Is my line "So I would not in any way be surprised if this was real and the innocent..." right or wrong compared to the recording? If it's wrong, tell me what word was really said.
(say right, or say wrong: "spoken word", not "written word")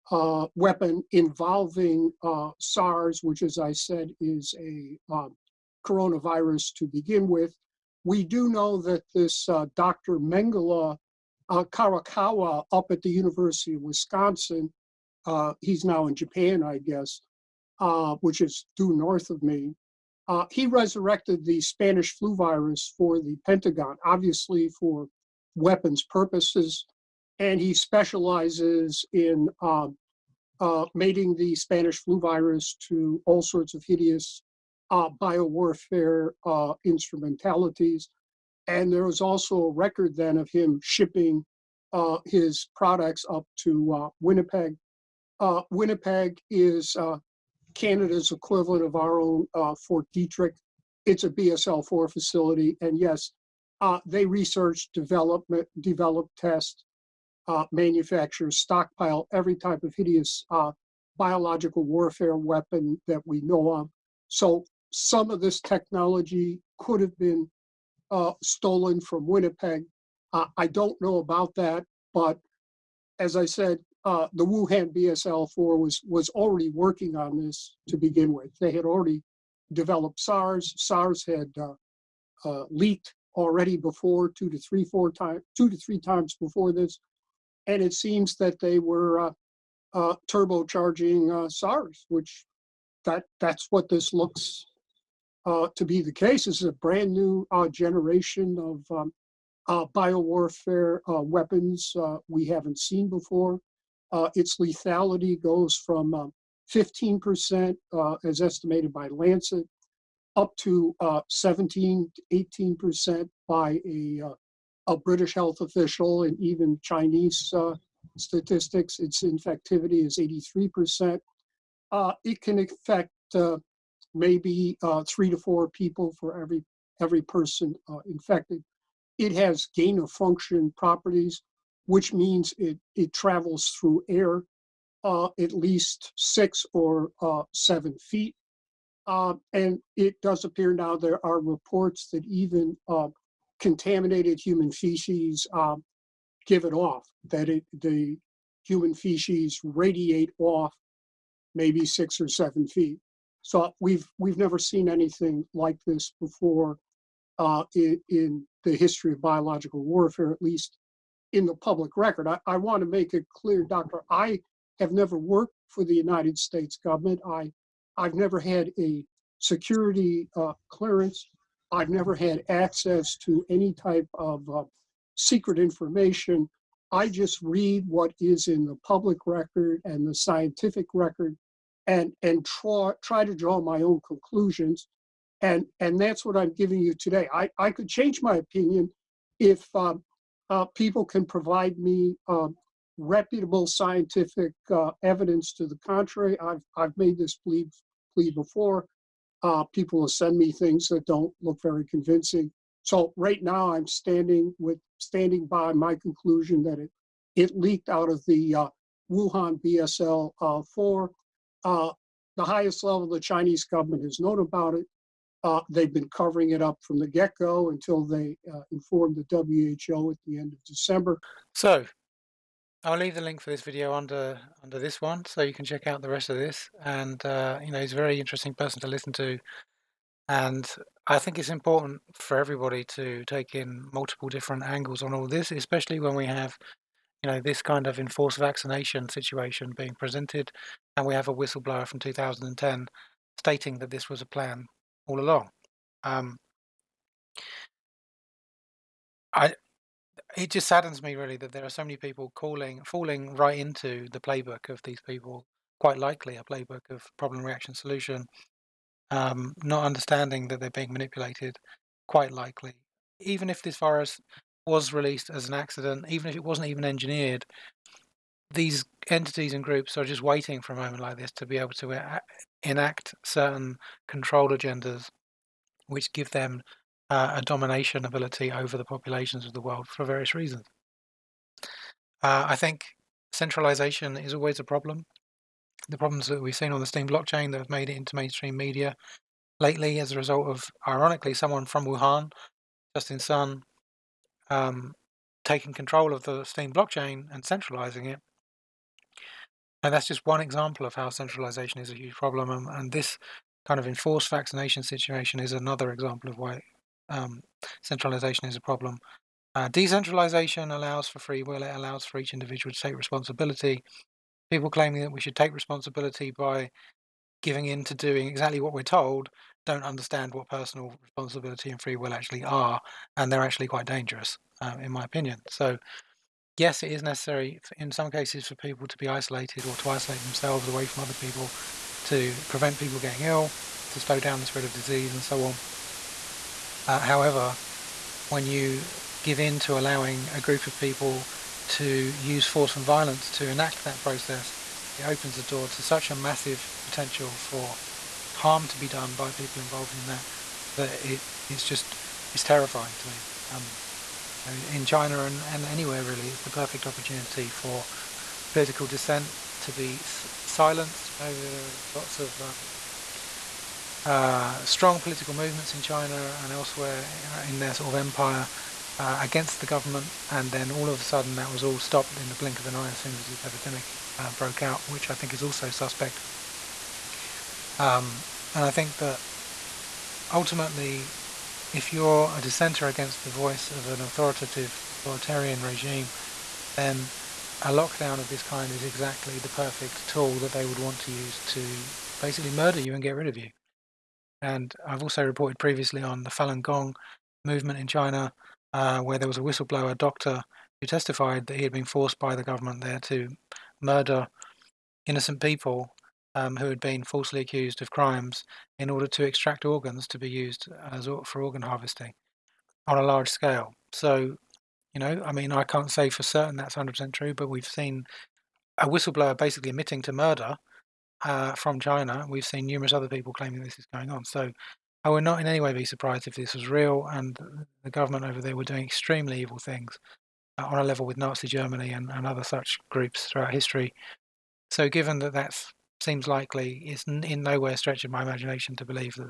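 wrong: "government", not "innocent".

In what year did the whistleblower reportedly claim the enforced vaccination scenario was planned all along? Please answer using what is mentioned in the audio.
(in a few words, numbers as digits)
2010.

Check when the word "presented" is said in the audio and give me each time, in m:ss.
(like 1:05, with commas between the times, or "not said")
3:59.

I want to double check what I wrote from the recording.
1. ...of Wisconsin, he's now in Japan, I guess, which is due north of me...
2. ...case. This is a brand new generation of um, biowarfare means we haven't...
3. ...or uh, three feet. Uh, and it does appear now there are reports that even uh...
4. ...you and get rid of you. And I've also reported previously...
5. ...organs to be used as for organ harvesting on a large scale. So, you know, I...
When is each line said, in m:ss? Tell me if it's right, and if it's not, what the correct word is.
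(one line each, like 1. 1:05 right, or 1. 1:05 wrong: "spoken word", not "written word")
1. 0:13 right
2. 1:36 wrong: "weapons", not "means"
3. 2:16 wrong: "seven", not "three"
4. 6:32 right
5. 6:49 right.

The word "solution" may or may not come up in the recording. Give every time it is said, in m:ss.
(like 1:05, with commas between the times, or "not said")
4:17.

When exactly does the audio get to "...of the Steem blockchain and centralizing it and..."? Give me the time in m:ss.
4:56.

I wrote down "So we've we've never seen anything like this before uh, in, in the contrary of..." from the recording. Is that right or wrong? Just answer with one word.
wrong.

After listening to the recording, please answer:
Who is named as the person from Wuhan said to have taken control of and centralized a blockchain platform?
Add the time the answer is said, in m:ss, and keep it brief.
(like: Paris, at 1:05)
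Justin Sun, at 4:52.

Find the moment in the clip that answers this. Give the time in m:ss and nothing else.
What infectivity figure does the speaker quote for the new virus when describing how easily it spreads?
2:00.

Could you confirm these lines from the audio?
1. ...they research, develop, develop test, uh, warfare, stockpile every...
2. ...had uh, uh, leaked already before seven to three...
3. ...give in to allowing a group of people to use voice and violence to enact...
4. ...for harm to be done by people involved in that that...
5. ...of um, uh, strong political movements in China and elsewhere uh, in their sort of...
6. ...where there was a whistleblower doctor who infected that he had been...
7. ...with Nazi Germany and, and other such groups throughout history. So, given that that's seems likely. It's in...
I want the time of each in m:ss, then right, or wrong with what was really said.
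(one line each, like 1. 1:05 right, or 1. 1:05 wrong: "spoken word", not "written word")
1. 0:54 wrong: "manufacture", not "warfare"
2. 1:21 wrong: "two", not "seven"
3. 5:39 wrong: "force", not "voice"
4. 5:47 right
5. 6:02 right
6. 6:39 wrong: "testified", not "infected"
7. 7:11 right.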